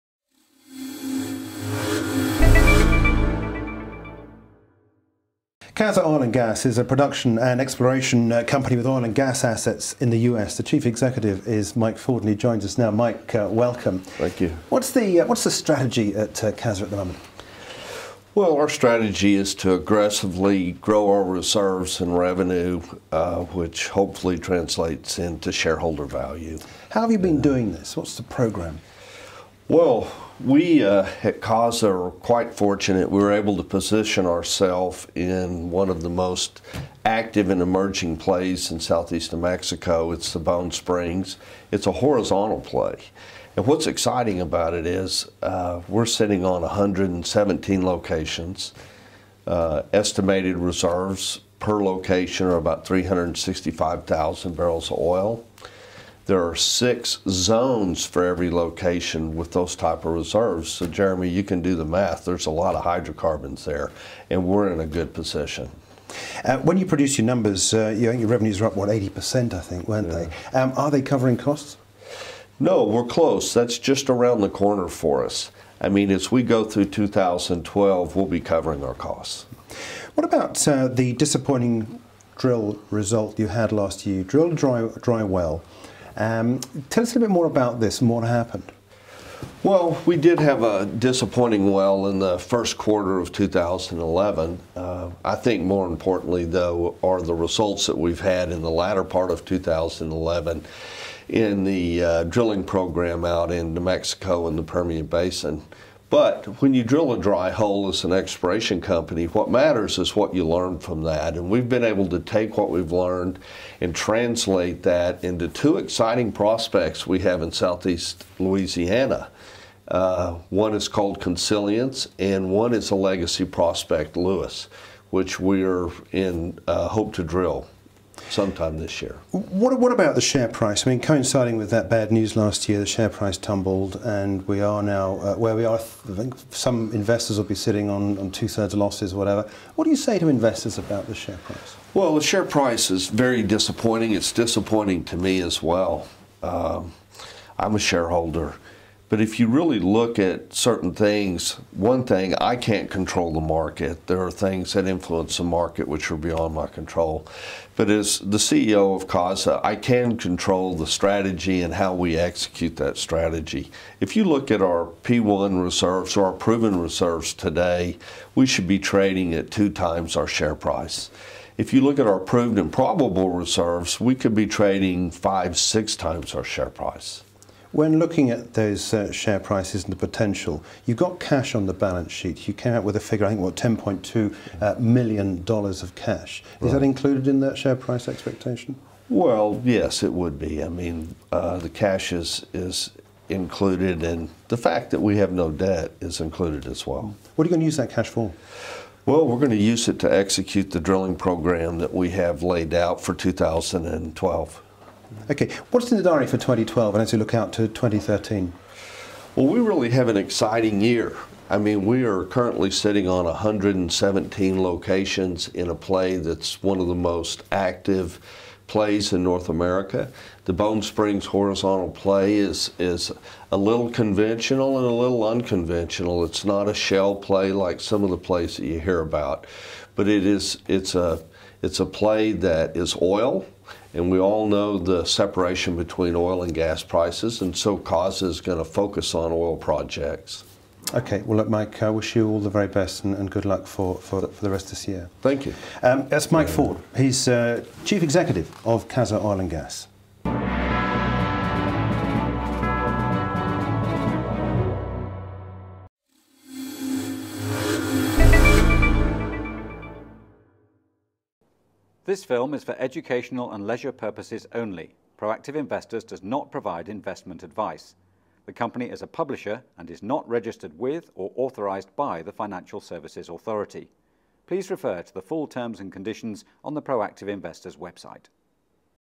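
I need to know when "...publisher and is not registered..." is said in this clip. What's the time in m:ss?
4:29.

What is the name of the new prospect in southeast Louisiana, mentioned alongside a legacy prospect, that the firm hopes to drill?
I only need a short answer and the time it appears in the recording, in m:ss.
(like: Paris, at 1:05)
Consilience, at 2:01.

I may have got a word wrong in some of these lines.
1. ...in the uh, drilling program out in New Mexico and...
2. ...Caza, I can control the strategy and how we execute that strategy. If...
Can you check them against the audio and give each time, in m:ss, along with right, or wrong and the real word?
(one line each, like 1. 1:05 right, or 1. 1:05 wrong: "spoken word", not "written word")
1. 1:41 right
2. 2:39 right.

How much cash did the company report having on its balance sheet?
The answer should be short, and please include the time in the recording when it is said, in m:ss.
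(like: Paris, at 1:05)
$10.2 million, at 3:03.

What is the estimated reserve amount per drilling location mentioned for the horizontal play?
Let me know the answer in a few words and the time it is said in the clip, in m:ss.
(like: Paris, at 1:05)
365,000 barrels, at 0:52.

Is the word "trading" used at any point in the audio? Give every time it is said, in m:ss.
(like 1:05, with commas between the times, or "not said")
2:48, 2:54.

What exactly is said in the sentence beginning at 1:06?
Uh, when you produce your numbers, uh, your, revenues are up, what, 80%, I think, weren't yeah.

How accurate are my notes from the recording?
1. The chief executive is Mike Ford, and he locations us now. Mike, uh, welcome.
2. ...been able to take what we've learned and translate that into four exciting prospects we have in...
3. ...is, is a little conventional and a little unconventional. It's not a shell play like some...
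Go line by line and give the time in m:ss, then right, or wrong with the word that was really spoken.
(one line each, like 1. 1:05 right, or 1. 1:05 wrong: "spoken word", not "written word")
1. 0:10 wrong: "joins", not "locations"
2. 1:51 wrong: "two", not "four"
3. 3:42 right.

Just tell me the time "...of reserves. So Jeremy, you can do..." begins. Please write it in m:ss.
1:00.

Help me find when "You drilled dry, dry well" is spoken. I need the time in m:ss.
1:24.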